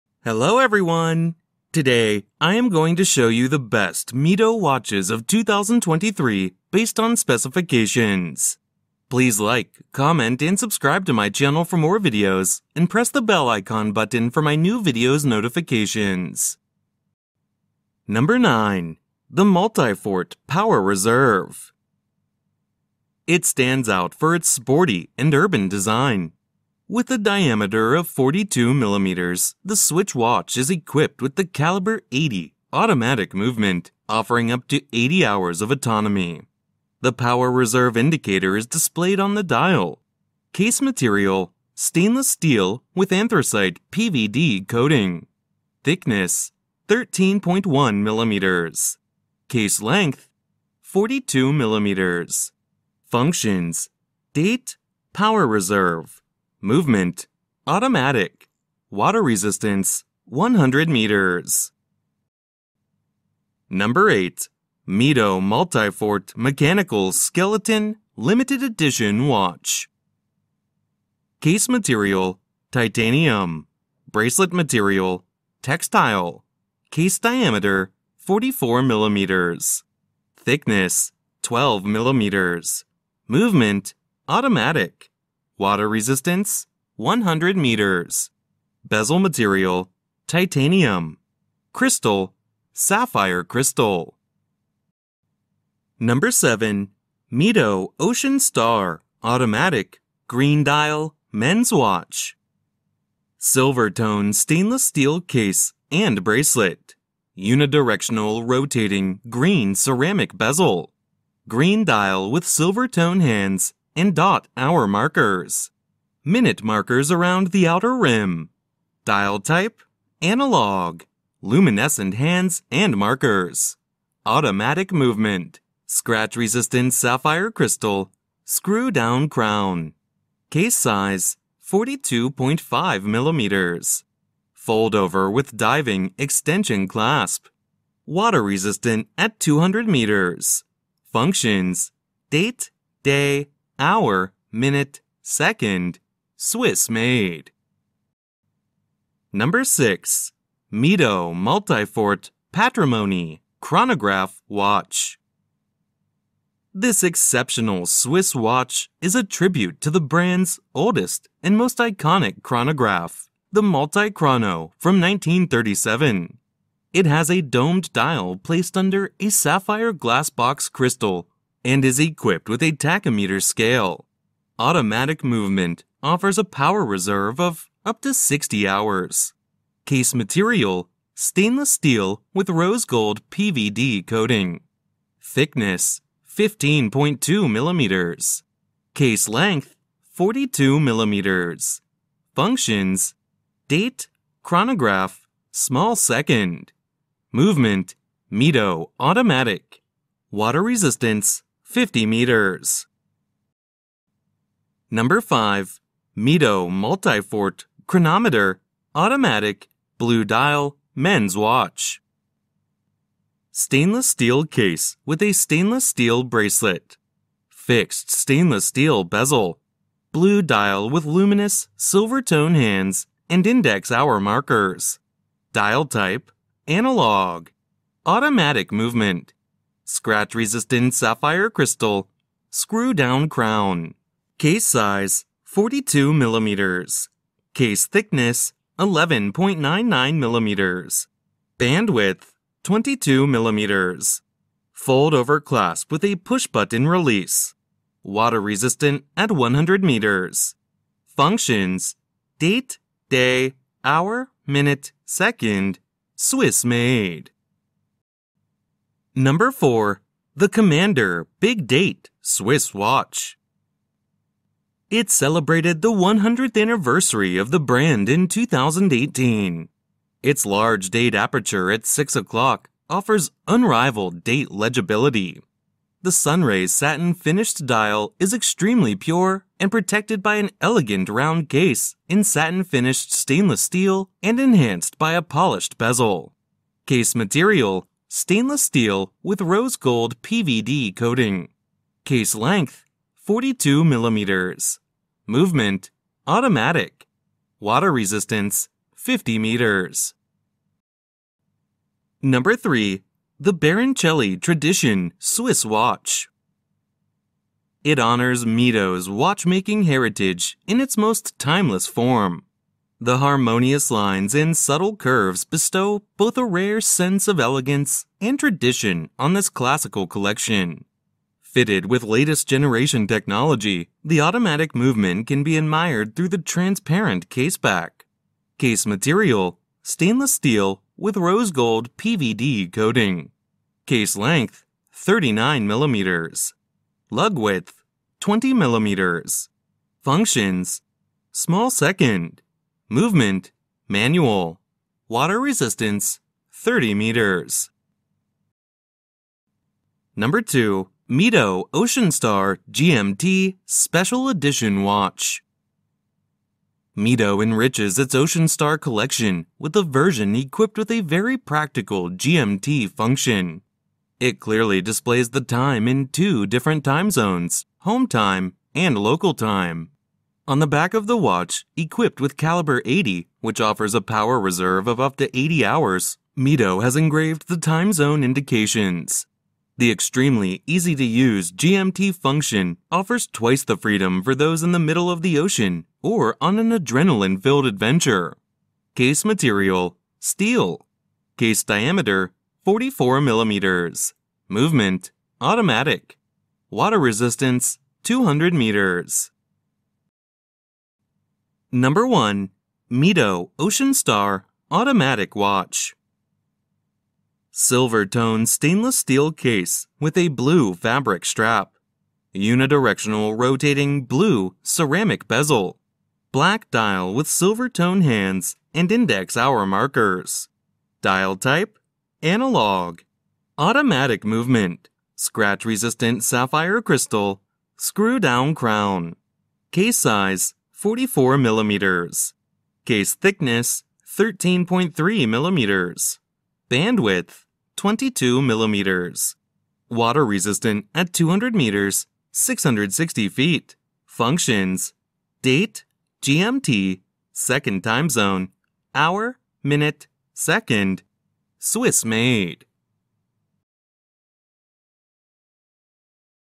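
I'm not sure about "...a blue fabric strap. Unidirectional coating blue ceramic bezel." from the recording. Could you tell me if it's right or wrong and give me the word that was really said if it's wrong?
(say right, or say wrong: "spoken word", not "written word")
wrong: "rotating", not "coating".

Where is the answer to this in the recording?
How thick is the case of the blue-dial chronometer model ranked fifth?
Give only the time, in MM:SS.
03:58.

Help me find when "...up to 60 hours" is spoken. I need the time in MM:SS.
02:57.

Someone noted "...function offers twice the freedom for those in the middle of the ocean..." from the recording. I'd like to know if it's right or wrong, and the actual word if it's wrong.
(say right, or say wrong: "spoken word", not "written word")
right.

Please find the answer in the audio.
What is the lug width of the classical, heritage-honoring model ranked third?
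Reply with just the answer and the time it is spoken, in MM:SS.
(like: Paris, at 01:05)
20 millimeters, at 05:38.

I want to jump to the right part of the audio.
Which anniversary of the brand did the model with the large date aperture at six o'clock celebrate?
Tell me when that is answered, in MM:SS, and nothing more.
04:25.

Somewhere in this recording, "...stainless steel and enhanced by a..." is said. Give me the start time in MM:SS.
04:43.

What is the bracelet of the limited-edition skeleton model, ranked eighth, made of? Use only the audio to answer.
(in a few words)
Textile.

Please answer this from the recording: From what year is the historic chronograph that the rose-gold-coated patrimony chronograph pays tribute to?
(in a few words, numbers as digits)
1937.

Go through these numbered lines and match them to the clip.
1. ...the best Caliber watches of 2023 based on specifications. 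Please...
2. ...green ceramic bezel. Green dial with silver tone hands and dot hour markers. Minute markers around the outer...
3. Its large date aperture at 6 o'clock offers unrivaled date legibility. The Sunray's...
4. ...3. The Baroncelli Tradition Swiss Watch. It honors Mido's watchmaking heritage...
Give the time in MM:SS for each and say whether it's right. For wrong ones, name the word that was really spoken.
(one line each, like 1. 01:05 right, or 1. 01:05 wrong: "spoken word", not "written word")
1. 00:03 wrong: "Mido", not "Caliber"
2. 01:49 right
3. 04:30 right
4. 05:02 right.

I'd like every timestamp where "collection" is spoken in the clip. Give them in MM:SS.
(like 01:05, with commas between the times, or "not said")
05:20, 05:58.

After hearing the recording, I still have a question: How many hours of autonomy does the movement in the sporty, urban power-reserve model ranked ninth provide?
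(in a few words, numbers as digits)
80 hours.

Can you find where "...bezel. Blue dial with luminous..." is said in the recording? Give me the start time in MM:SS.
03:39.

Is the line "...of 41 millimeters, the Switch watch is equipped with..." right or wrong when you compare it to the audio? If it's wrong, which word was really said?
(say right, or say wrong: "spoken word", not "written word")
wrong: "42", not "41".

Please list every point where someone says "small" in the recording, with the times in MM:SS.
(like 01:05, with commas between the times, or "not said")
03:15, 05:41.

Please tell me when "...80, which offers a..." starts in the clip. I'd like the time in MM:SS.
06:12.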